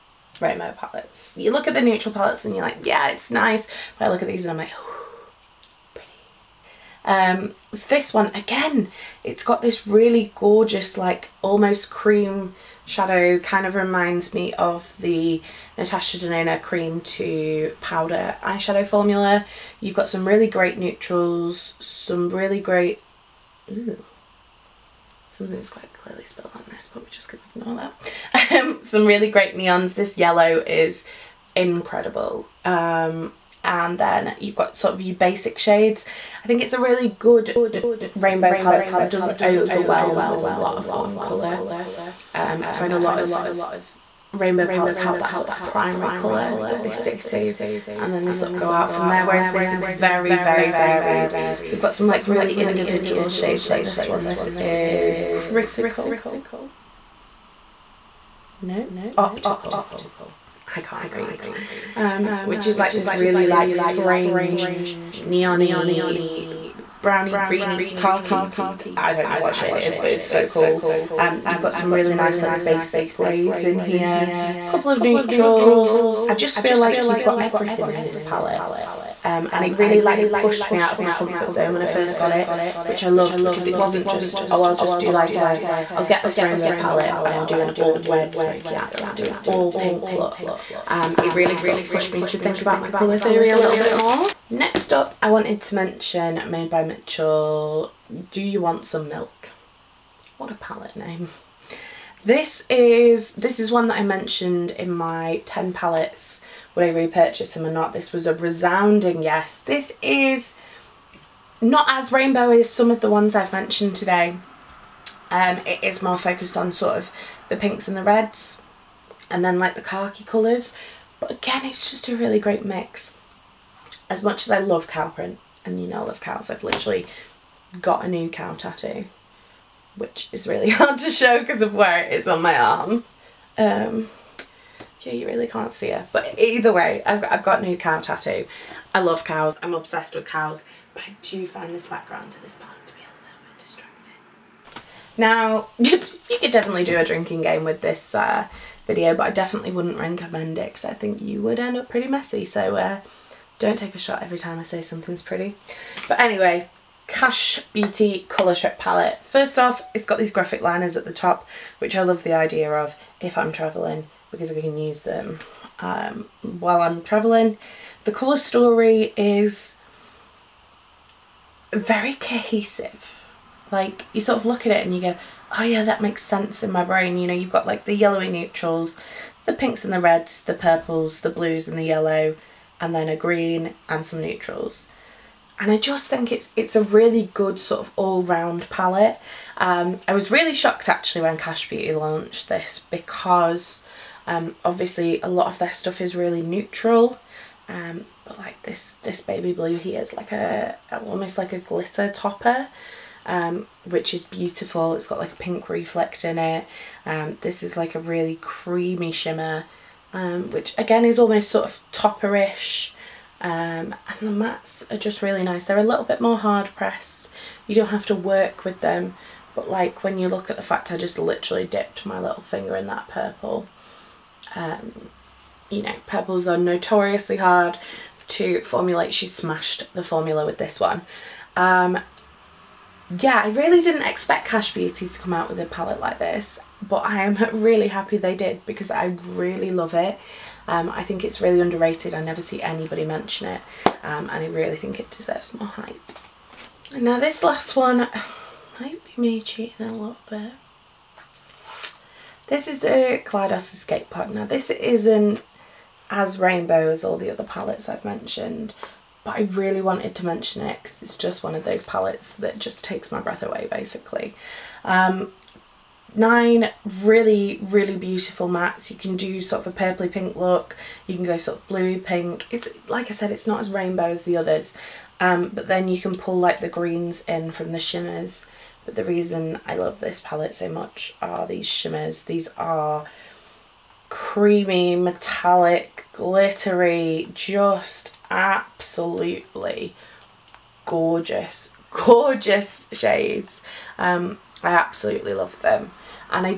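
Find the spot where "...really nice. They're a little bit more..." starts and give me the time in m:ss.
3:35.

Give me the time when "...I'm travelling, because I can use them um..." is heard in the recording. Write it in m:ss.
2:43.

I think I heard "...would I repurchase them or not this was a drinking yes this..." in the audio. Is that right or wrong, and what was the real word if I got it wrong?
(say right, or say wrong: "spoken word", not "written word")
wrong: "resounding", not "drinking".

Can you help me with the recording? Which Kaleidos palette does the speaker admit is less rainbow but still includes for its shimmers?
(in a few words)
Escape Pod.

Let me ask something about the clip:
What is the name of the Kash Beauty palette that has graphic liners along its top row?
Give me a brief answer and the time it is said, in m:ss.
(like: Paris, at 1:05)
Colour Strip Palette, at 2:38.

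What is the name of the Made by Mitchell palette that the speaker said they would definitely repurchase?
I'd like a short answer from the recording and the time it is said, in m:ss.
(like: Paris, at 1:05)
Do You Want Some Milk?, at 1:38.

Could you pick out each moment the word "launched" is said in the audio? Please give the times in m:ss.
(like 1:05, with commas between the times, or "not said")
3:11.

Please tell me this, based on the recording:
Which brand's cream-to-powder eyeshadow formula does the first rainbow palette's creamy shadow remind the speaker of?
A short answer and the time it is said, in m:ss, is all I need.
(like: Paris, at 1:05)
Natasha Denona, at 0:15.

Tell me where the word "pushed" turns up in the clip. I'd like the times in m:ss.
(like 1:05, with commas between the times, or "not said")
1:20, 1:31.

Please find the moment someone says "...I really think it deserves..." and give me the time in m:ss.
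4:04.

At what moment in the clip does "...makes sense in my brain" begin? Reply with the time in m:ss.
2:56.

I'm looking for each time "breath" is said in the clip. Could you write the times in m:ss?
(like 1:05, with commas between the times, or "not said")
4:23.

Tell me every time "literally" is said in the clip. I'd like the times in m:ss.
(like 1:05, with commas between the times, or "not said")
2:06, 3:41.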